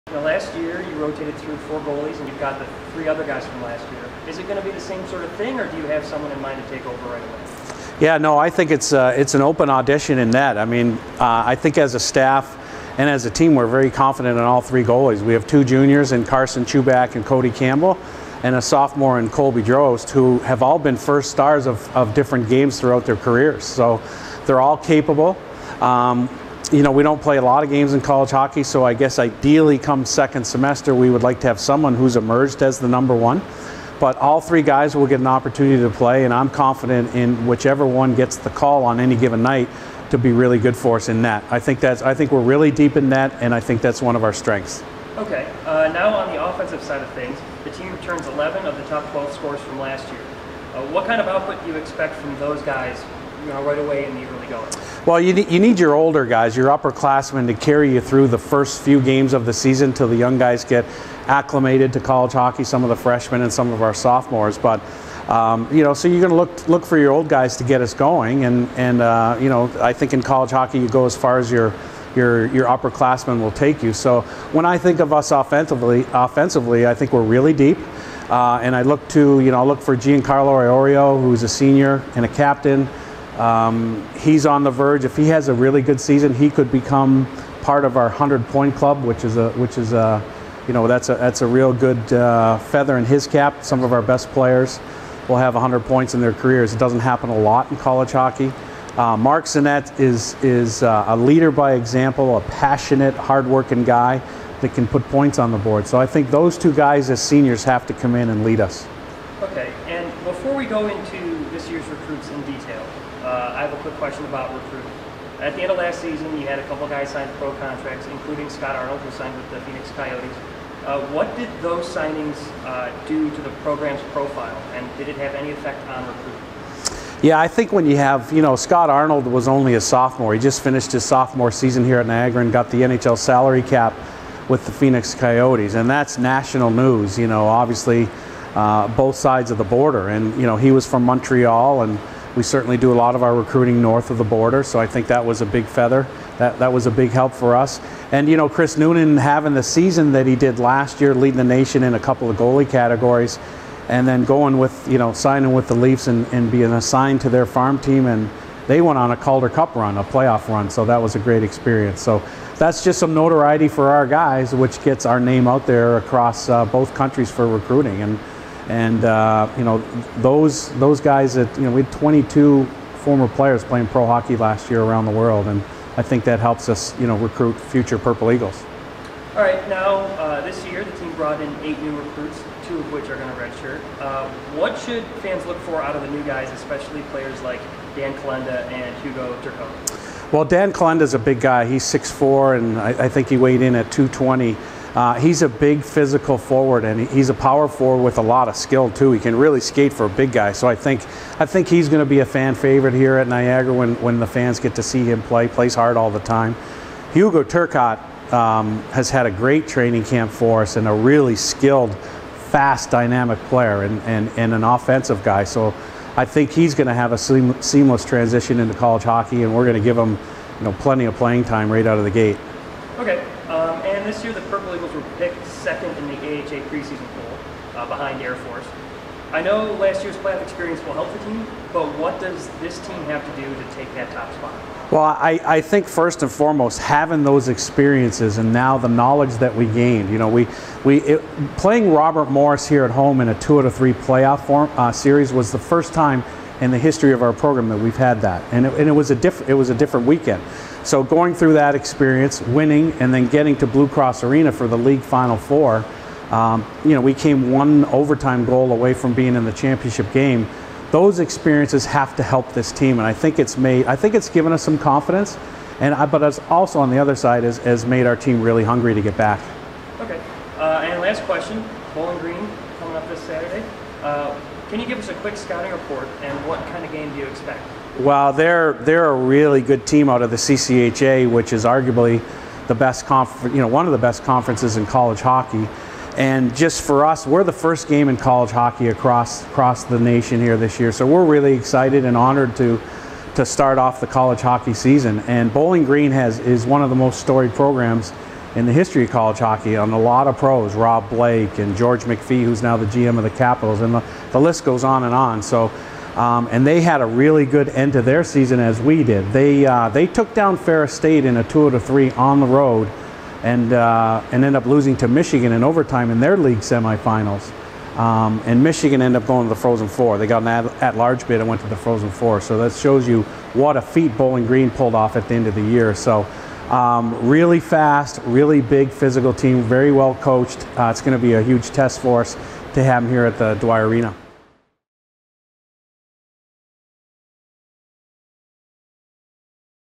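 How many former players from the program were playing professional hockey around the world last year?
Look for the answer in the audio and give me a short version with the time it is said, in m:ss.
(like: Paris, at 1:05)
22, at 2:51.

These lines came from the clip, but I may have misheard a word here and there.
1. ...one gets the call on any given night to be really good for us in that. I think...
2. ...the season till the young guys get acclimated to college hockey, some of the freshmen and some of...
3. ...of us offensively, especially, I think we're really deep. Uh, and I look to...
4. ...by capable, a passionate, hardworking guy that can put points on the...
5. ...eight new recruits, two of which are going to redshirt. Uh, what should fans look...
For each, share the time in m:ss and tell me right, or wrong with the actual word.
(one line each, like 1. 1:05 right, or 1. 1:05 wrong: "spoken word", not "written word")
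1. 0:37 right
2. 0:59 right
3. 1:15 wrong: "offensively", not "especially"
4. 1:41 wrong: "example", not "capable"
5. 3:01 right.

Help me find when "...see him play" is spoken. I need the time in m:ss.
3:24.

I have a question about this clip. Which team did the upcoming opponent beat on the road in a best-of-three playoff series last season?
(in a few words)
Ferris State.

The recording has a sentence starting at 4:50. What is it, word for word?
So we're really excited and honored to to start off the college hockey season.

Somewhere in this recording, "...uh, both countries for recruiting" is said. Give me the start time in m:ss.
2:46.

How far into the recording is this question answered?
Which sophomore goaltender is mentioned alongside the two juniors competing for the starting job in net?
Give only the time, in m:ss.
0:19.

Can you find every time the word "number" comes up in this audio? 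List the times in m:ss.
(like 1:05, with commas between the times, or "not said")
0:32.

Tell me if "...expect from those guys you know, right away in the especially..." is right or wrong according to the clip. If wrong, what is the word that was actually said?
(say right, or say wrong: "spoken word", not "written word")
wrong: "early", not "especially".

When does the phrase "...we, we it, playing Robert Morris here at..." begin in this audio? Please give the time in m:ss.
4:00.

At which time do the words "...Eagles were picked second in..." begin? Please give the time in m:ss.
3:44.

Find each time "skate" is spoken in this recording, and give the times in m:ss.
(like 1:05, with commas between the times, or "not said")
3:19.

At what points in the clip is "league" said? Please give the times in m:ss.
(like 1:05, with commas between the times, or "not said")
4:14, 5:16.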